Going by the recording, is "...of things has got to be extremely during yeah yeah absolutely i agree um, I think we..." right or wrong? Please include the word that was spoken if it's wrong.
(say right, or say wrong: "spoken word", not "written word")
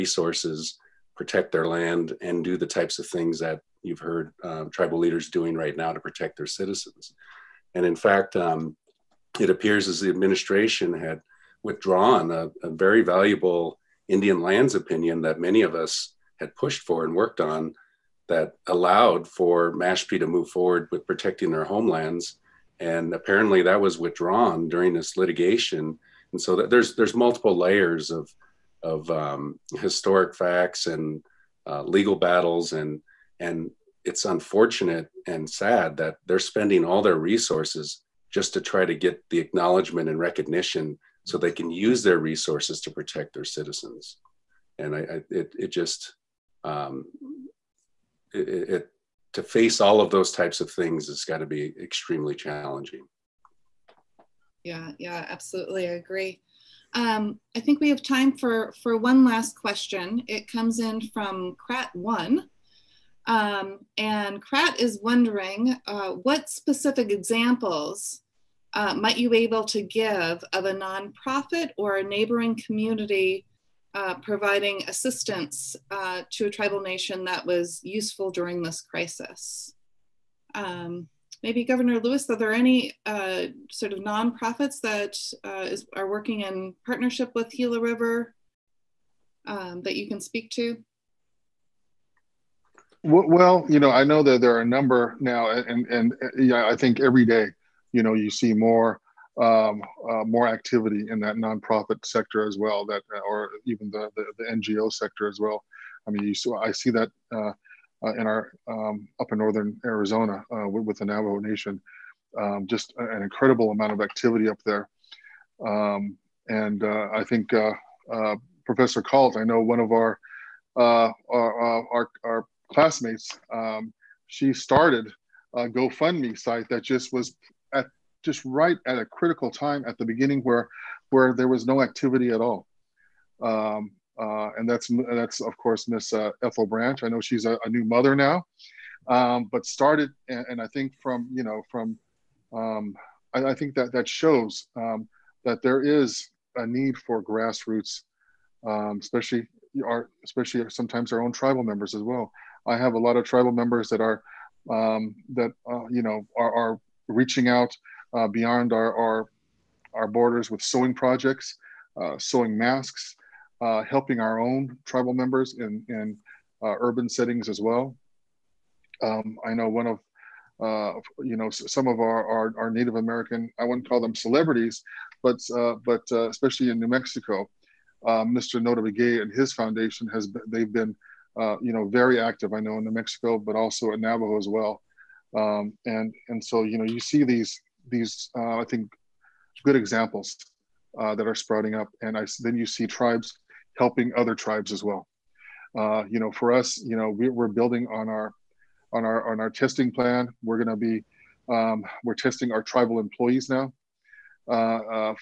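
wrong: "challenging", not "during".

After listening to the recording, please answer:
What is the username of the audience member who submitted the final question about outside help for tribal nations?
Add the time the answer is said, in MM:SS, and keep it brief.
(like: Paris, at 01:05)
Krat1, at 01:01.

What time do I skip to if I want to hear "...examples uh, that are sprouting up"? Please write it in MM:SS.
03:09.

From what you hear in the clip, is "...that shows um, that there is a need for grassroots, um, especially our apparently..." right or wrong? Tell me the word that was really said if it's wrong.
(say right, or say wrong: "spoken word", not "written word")
wrong: "especially", not "apparently".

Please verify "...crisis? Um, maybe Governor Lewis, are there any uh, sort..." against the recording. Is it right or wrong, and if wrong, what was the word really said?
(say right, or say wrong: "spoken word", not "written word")
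right.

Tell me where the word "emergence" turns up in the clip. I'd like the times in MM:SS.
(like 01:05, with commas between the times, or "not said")
not said.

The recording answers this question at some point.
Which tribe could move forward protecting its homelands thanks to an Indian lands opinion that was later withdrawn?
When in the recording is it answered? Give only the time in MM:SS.
00:19.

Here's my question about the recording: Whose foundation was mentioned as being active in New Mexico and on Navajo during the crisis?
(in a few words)
Notah Begay.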